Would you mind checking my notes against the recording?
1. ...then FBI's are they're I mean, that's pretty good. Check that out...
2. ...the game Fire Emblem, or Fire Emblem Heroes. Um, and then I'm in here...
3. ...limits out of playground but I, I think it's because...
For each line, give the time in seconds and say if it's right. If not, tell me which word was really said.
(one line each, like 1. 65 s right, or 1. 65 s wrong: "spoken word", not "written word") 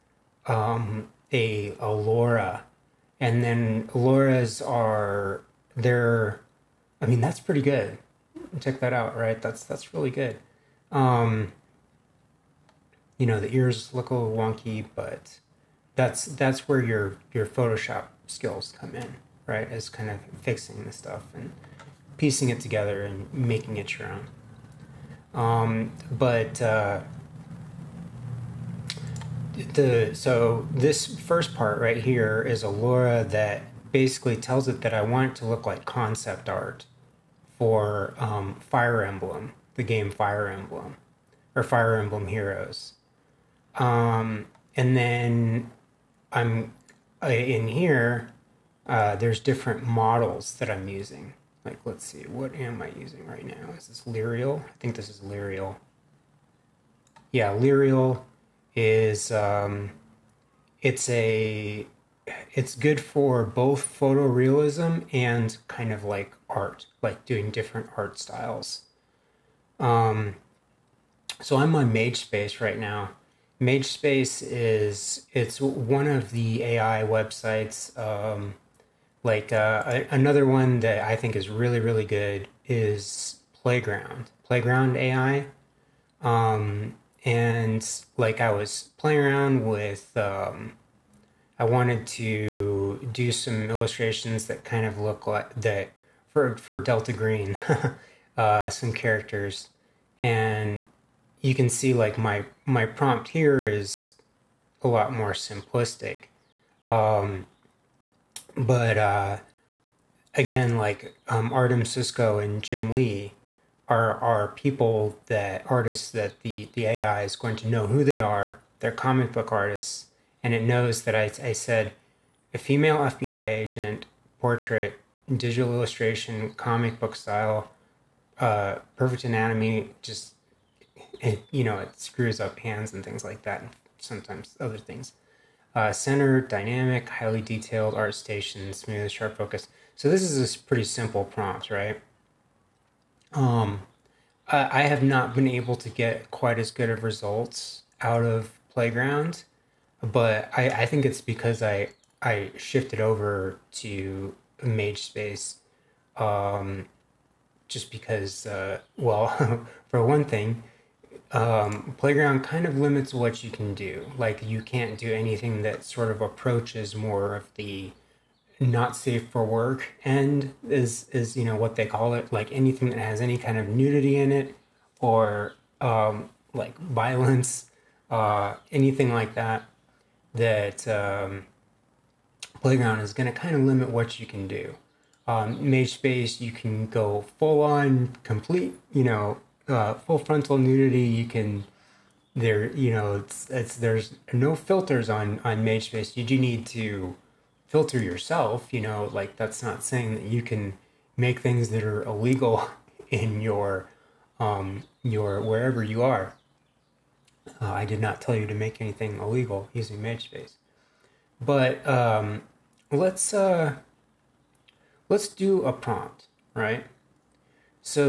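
1. 3 s wrong: "LoRA", not "FBI"
2. 39 s right
3. 147 s wrong: "results", not "limits".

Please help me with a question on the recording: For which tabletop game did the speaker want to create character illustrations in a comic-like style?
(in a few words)
Delta Green.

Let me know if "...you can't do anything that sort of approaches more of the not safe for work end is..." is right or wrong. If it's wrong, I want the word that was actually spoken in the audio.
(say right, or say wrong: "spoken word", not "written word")
right.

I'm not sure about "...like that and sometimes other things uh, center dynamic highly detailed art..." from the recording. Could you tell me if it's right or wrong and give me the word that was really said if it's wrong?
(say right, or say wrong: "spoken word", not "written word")
right.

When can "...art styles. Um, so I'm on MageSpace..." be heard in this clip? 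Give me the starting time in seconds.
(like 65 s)
67 s.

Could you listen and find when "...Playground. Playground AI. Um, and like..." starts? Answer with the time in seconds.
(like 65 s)
83 s.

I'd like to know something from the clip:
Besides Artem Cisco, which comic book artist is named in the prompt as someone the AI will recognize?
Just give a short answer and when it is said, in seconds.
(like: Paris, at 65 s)
Jim Lee, at 112 s.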